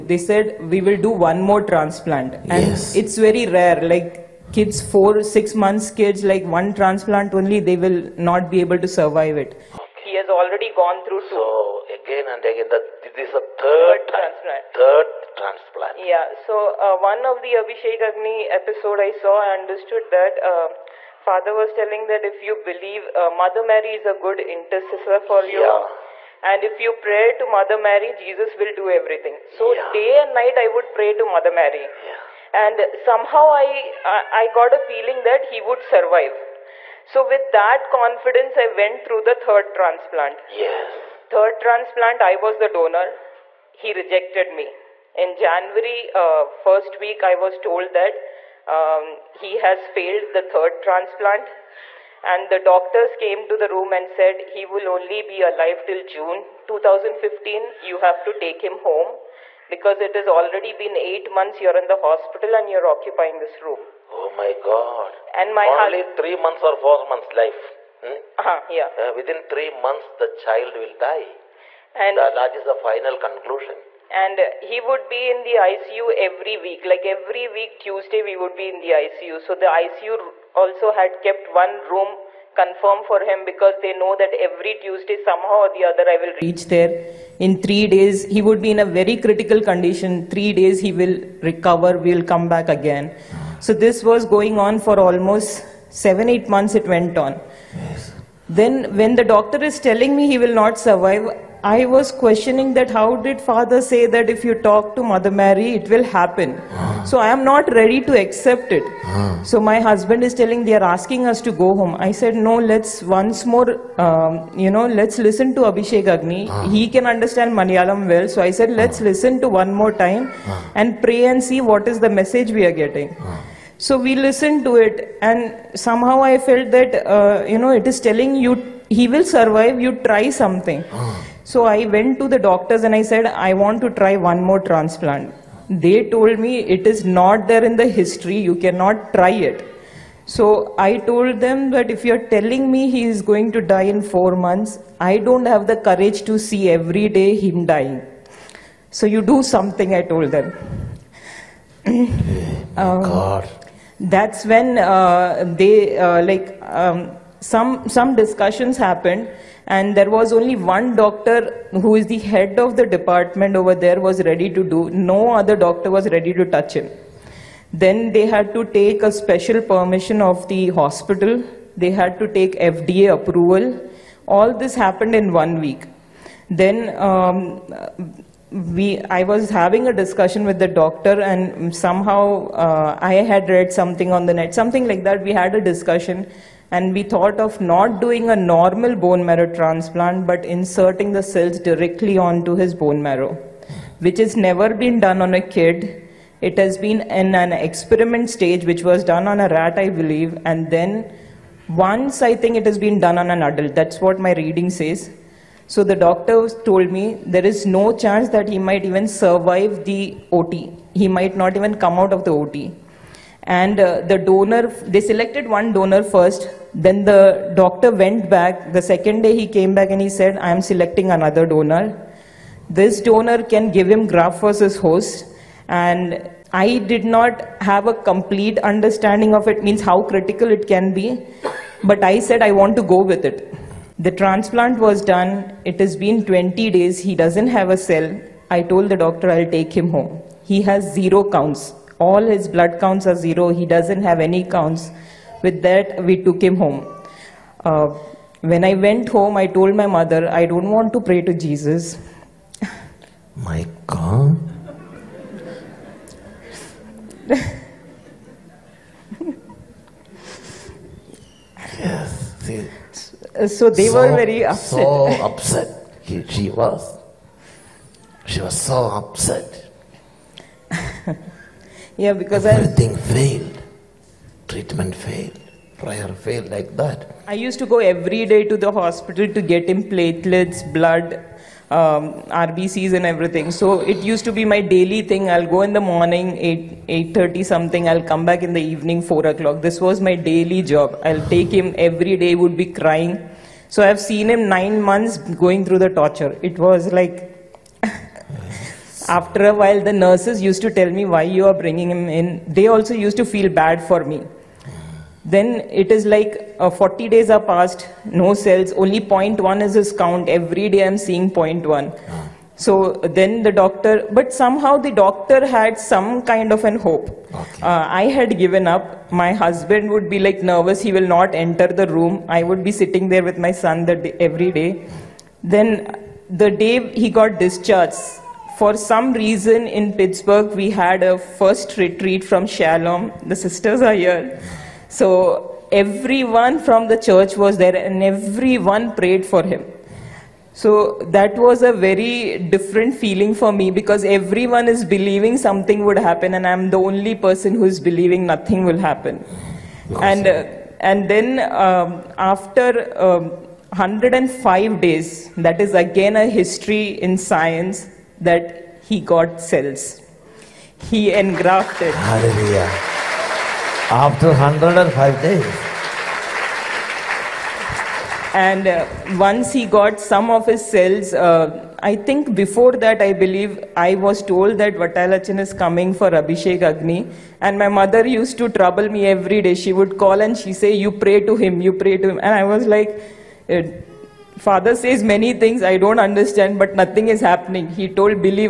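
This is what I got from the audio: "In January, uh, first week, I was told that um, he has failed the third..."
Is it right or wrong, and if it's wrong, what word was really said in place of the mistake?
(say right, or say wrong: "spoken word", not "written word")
right.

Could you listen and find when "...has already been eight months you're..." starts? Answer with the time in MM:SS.
01:00.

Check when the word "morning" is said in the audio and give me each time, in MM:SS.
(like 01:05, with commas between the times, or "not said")
04:45.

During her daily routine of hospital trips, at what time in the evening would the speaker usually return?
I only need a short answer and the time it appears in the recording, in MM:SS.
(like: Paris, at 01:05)
4 o'clock, at 04:49.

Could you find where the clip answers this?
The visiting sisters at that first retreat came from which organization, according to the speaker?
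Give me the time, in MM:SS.
05:32.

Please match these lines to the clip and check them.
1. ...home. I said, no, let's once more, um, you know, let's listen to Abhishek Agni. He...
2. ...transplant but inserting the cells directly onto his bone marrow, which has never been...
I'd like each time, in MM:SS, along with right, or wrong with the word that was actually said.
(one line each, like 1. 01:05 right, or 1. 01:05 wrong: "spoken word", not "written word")
1. 01:51 right
2. 03:09 right.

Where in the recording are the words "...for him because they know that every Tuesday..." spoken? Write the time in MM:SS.
01:23.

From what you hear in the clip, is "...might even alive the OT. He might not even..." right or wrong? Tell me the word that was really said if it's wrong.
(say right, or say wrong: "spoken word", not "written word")
wrong: "survive", not "alive".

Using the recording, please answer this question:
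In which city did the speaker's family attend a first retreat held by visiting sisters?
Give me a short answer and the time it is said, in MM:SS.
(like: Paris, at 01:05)
Pittsburgh, at 05:29.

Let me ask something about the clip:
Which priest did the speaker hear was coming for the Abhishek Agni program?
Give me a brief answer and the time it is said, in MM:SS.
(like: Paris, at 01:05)
Vatalachan, at 06:14.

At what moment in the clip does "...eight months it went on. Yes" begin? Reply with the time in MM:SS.
01:36.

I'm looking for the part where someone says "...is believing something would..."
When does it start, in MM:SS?
05:44.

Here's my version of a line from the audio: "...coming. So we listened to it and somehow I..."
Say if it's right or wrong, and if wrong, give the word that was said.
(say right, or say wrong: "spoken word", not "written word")
wrong: "getting", not "coming".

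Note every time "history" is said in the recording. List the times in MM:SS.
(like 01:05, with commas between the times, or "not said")
02:17, 05:56.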